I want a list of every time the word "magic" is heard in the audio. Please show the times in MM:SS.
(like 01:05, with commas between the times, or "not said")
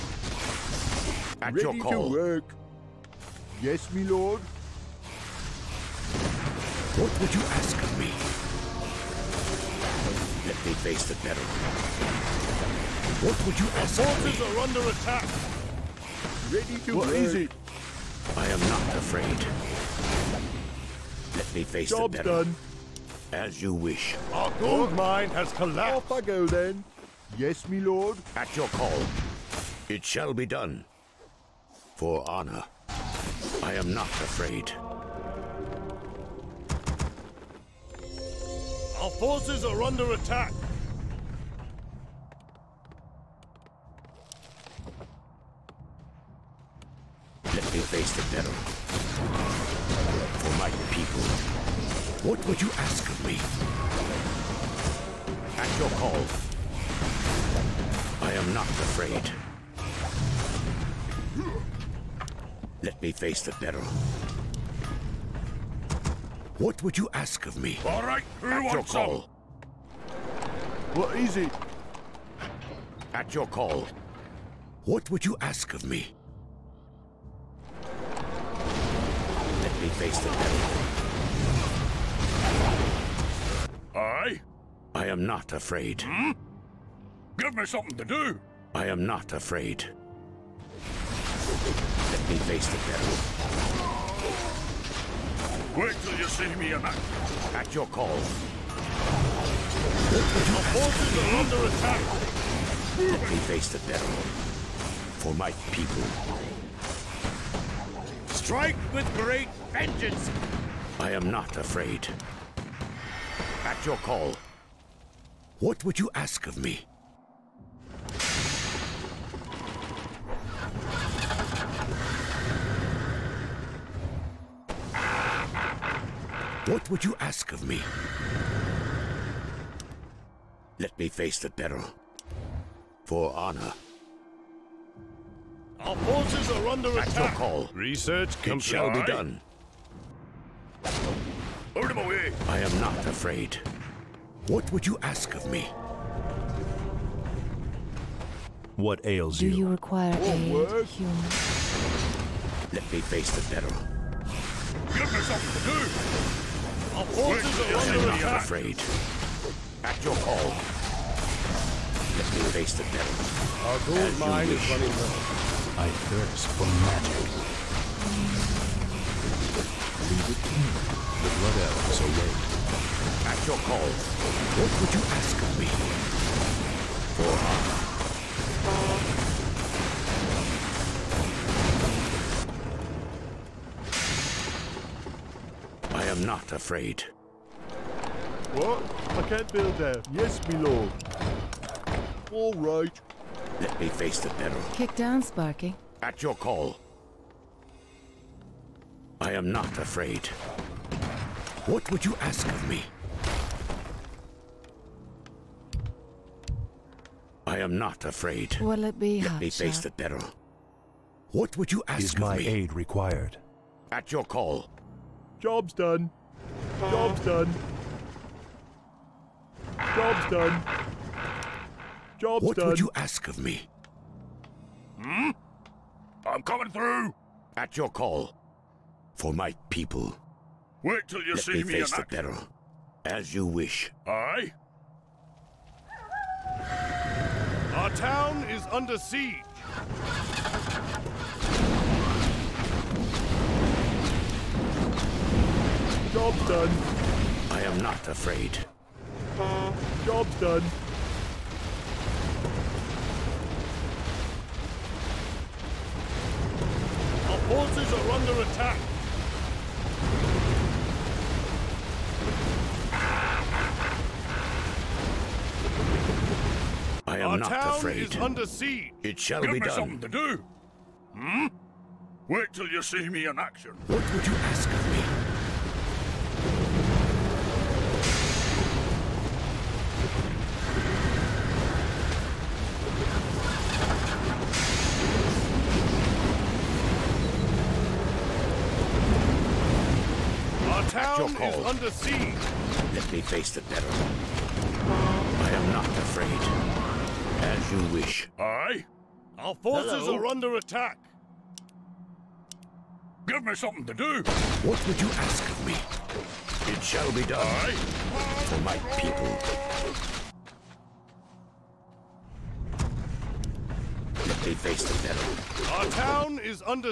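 02:46.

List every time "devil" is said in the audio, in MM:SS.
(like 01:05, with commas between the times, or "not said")
01:20, 01:32, 01:43, 02:42.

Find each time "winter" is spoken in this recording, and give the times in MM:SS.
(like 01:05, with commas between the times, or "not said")
not said.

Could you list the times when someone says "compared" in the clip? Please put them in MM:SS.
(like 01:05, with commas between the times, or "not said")
not said.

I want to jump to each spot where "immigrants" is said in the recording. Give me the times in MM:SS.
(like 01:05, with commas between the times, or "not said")
not said.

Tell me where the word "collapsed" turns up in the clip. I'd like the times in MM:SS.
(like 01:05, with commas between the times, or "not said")
00:25.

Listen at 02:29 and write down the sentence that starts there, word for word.
Do you require oh, aid, human?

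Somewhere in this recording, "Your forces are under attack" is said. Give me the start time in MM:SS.
01:40.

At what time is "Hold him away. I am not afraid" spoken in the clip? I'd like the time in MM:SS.
02:21.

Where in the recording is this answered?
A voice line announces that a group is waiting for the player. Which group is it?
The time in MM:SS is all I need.
02:51.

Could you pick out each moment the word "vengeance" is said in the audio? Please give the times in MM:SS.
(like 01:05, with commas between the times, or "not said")
01:49.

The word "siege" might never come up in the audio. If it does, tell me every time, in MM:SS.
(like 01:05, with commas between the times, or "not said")
03:58, 04:28, 04:51.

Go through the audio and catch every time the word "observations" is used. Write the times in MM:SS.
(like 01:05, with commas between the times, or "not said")
not said.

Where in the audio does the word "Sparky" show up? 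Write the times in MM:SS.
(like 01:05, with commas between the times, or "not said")
03:15.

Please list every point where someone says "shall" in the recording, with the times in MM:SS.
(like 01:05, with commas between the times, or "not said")
00:30, 02:18, 04:29, 05:06.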